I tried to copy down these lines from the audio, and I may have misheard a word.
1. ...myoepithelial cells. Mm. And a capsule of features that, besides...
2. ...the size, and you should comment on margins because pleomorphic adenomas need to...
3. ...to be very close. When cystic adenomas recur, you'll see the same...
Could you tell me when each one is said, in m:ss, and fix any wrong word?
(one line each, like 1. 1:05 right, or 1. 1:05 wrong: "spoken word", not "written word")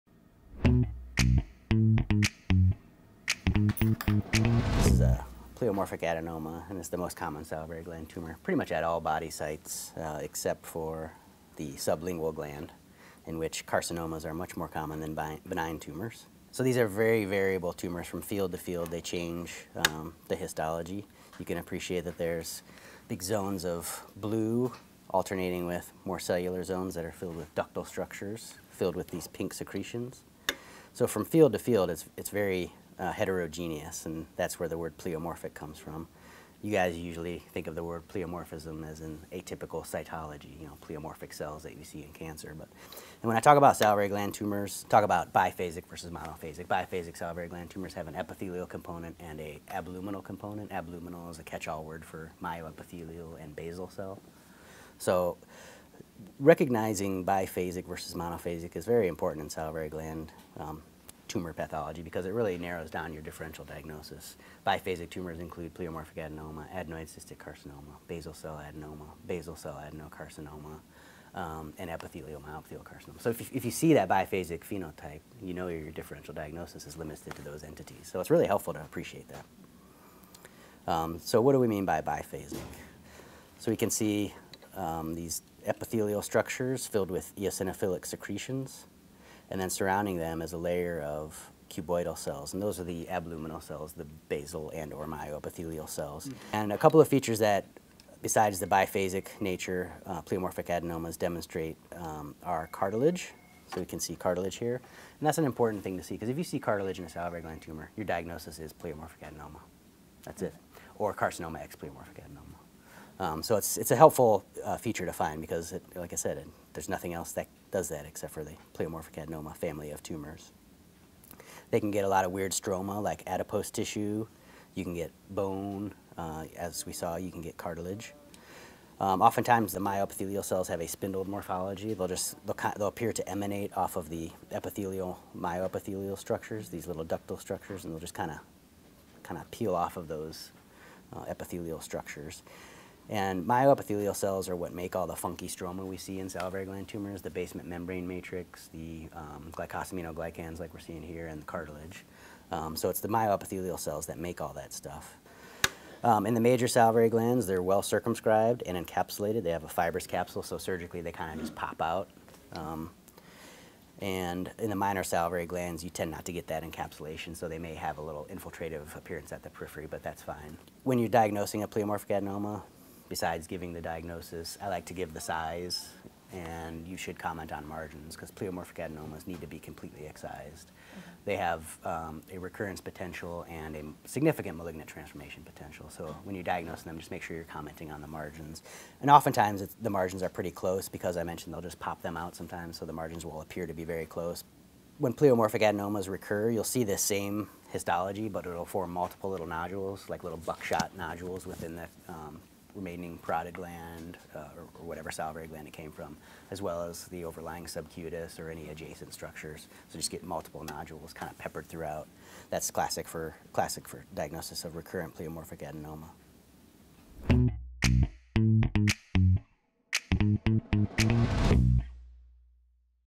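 1. 1:35 wrong: "couple", not "capsule"
2. 2:55 right
3. 3:13 wrong: "pleomorphic", not "cystic".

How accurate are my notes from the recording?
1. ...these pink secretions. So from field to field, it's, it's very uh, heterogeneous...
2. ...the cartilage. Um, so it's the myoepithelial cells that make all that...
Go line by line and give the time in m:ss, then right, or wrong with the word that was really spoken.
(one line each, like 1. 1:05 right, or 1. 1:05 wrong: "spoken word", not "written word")
1. 0:29 right
2. 2:31 right.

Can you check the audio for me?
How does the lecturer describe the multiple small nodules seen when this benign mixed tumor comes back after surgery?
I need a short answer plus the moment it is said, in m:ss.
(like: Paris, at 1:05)
buckshot nodules, at 3:20.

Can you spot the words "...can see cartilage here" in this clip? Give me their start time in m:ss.
1:43.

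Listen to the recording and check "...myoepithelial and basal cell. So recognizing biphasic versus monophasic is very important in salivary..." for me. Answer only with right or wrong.
right.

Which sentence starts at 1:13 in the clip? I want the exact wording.
So if you, if you see that biphasic phenotype, you know your differential diagnosis is limited to those entities.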